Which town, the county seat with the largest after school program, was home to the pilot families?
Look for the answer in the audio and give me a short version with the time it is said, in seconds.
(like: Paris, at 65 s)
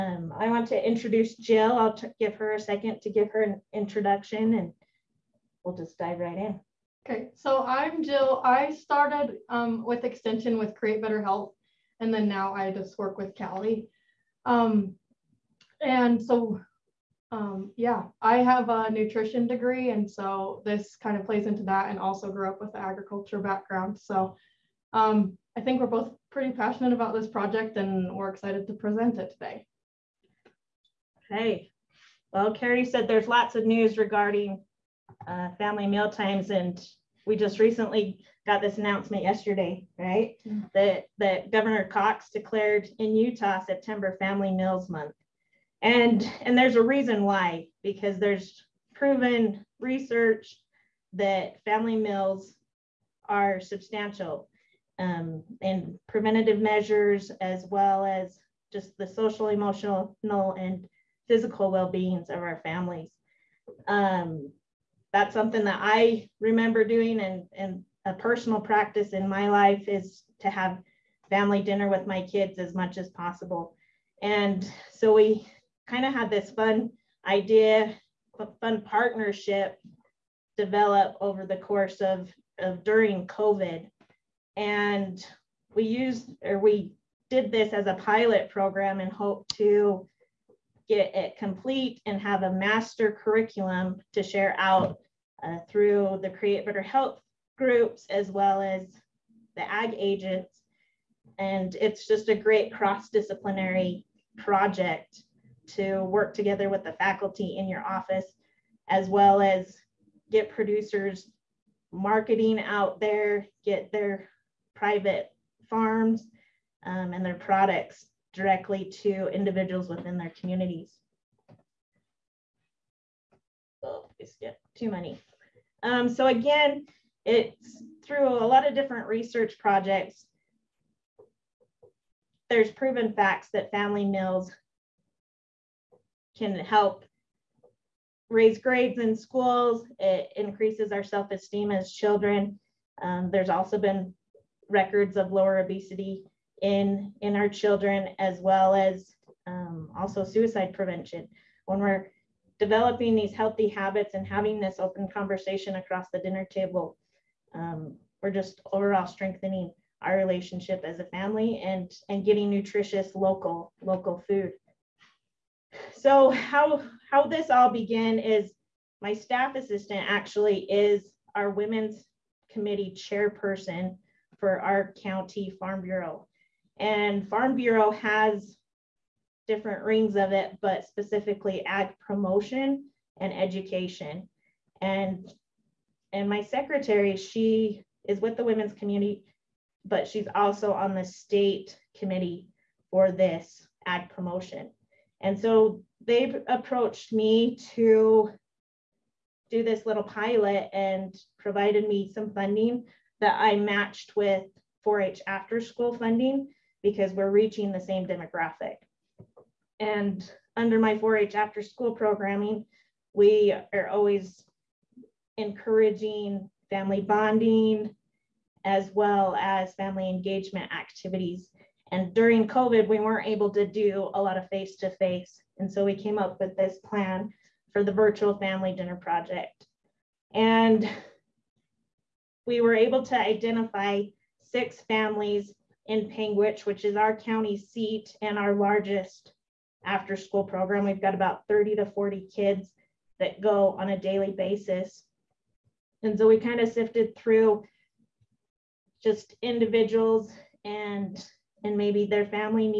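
Panguitch, at 236 s.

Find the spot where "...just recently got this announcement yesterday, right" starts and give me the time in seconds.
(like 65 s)
37 s.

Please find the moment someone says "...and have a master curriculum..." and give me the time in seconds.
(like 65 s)
92 s.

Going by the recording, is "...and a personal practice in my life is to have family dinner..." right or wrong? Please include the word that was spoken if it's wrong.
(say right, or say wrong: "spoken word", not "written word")
right.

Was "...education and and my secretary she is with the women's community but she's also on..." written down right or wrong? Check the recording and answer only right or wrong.
right.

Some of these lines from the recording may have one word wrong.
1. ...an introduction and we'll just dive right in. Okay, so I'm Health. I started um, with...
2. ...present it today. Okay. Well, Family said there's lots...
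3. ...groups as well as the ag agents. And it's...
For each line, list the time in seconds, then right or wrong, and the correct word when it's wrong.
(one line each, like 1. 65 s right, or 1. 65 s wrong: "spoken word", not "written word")
1. 3 s wrong: "Jill", not "Health"
2. 28 s wrong: "Carrie", not "Family"
3. 97 s right.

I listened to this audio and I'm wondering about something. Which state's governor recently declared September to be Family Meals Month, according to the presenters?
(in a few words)
Utah.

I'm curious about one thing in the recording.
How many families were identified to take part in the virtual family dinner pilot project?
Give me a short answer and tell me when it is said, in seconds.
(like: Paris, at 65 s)
6, at 234 s.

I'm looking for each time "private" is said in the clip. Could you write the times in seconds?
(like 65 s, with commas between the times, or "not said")
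114 s.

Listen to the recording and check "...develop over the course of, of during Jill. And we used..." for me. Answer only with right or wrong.
wrong.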